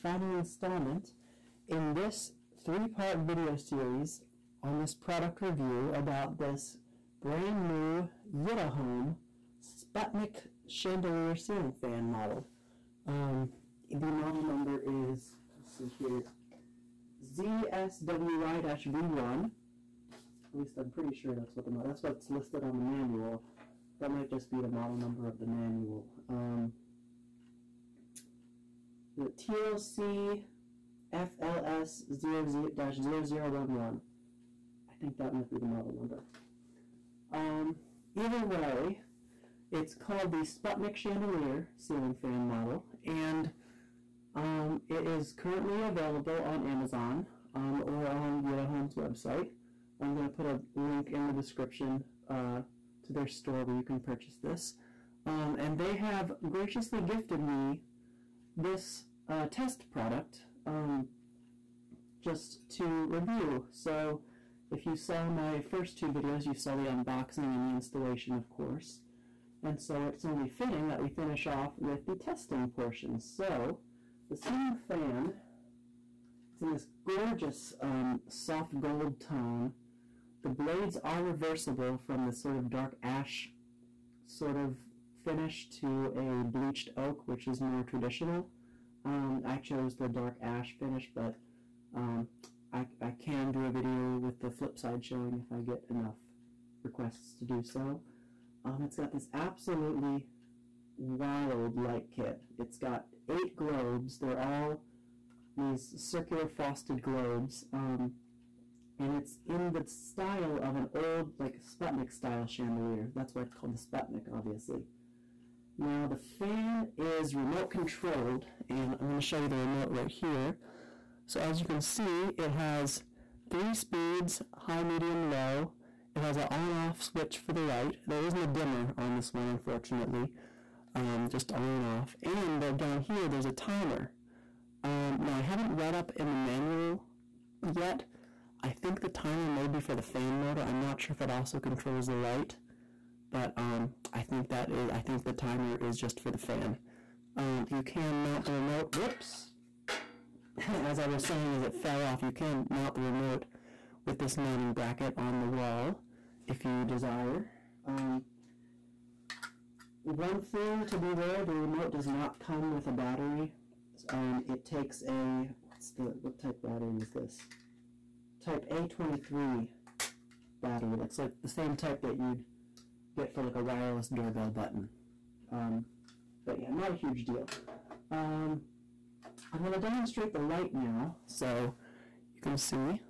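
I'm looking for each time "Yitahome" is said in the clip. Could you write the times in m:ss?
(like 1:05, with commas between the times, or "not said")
0:08, 0:48.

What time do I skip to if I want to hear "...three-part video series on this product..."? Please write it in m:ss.
0:02.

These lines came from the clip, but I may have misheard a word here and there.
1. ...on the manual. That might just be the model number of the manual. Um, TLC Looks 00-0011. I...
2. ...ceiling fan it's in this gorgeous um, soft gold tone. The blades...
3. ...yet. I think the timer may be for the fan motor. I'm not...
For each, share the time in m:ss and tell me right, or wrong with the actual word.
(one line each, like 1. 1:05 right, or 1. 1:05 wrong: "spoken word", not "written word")
1. 0:22 wrong: "FLS", not "Looks"
2. 1:14 right
3. 2:17 right.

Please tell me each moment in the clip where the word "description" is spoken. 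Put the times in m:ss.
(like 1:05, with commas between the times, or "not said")
0:51.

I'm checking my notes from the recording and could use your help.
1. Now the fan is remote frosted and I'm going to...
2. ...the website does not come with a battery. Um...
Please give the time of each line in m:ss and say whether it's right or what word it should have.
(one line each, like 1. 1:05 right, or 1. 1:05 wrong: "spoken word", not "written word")
1. 1:55 wrong: "controlled", not "frosted"
2. 2:41 wrong: "remote", not "website".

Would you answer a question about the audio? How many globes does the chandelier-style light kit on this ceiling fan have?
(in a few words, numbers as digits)
8.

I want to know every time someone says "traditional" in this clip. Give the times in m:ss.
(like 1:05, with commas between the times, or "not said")
1:27.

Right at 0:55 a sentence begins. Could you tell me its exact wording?
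Um, and they have graciously gifted me this test product um, just to review.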